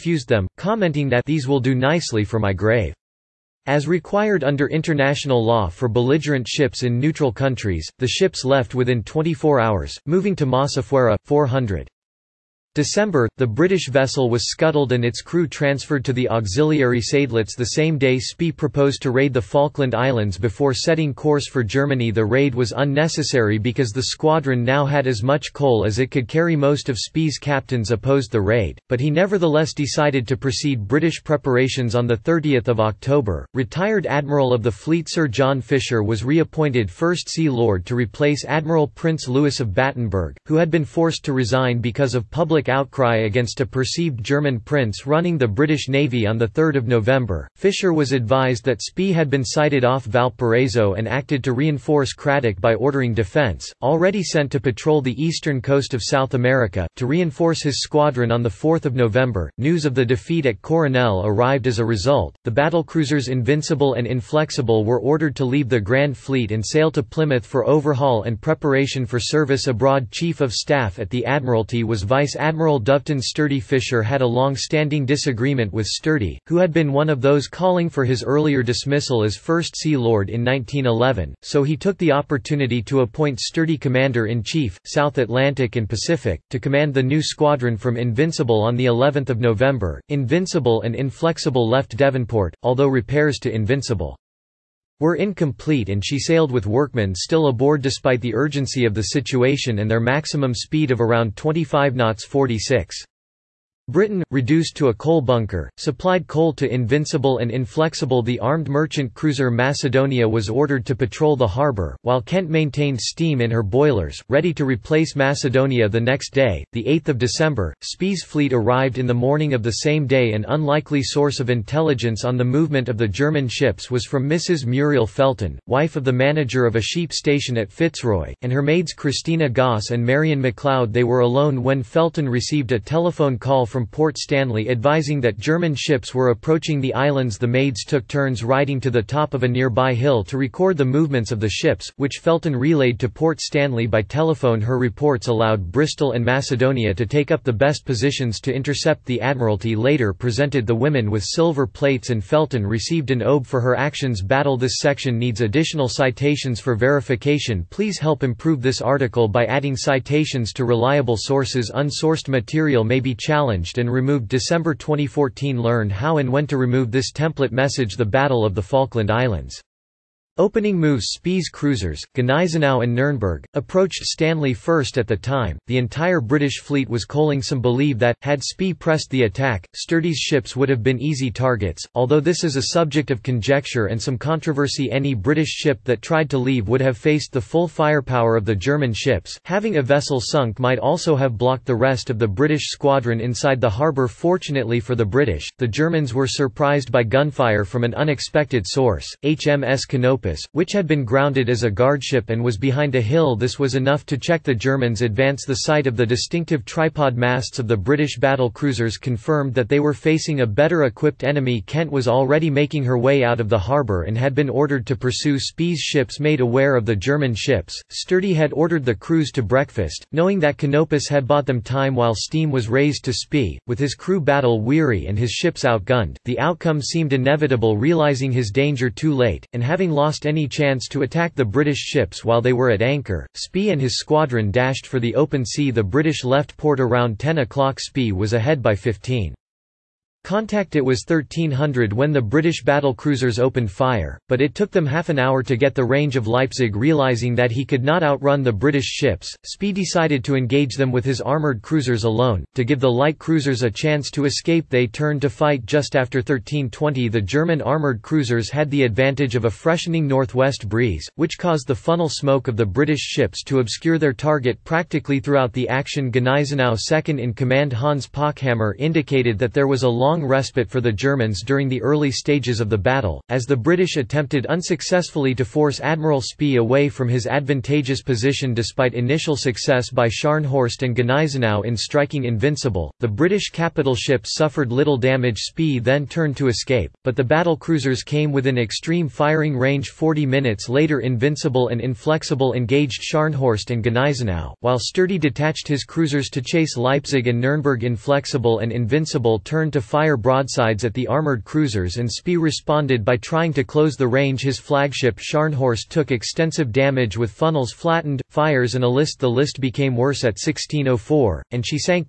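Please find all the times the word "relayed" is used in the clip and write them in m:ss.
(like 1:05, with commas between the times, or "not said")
2:22.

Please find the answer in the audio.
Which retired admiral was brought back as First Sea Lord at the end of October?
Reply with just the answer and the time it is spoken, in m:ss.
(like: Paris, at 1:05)
Sir John Fisher, at 0:35.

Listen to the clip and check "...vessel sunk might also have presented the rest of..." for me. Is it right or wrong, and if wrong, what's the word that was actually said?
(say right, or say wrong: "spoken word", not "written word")
wrong: "blocked", not "presented".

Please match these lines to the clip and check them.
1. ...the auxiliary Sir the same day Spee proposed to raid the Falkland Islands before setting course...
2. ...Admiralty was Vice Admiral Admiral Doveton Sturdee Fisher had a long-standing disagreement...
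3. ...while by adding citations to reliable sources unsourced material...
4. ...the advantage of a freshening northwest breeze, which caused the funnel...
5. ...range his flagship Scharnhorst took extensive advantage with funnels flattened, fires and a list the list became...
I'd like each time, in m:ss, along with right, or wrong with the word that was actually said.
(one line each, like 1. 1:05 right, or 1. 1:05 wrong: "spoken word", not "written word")
1. 0:16 wrong: "Seydlitz", not "Sir"
2. 1:11 right
3. 2:38 wrong: "article", not "while"
4. 4:18 right
5. 5:04 wrong: "damage", not "advantage".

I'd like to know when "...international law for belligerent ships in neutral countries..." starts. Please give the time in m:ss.
0:04.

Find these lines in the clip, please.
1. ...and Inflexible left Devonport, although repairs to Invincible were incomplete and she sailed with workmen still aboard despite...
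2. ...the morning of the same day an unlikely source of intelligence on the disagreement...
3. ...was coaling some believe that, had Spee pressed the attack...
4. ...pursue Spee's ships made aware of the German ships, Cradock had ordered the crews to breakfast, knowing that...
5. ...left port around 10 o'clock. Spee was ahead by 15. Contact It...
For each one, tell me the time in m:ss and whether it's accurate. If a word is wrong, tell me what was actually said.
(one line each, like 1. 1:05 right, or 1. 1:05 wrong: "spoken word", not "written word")
1. 1:30 right
2. 1:59 wrong: "movement", not "disagreement"
3. 2:56 right
4. 3:34 wrong: "Sturdee", not "Cradock"
5. 3:56 right.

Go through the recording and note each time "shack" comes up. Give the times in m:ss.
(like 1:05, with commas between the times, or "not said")
not said.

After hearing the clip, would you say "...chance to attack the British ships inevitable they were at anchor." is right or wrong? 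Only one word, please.
wrong.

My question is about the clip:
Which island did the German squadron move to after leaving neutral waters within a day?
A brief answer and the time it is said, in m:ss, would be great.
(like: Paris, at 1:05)
Masafuera, at 0:10.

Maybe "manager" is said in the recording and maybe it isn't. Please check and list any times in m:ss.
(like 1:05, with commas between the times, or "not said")
2:06.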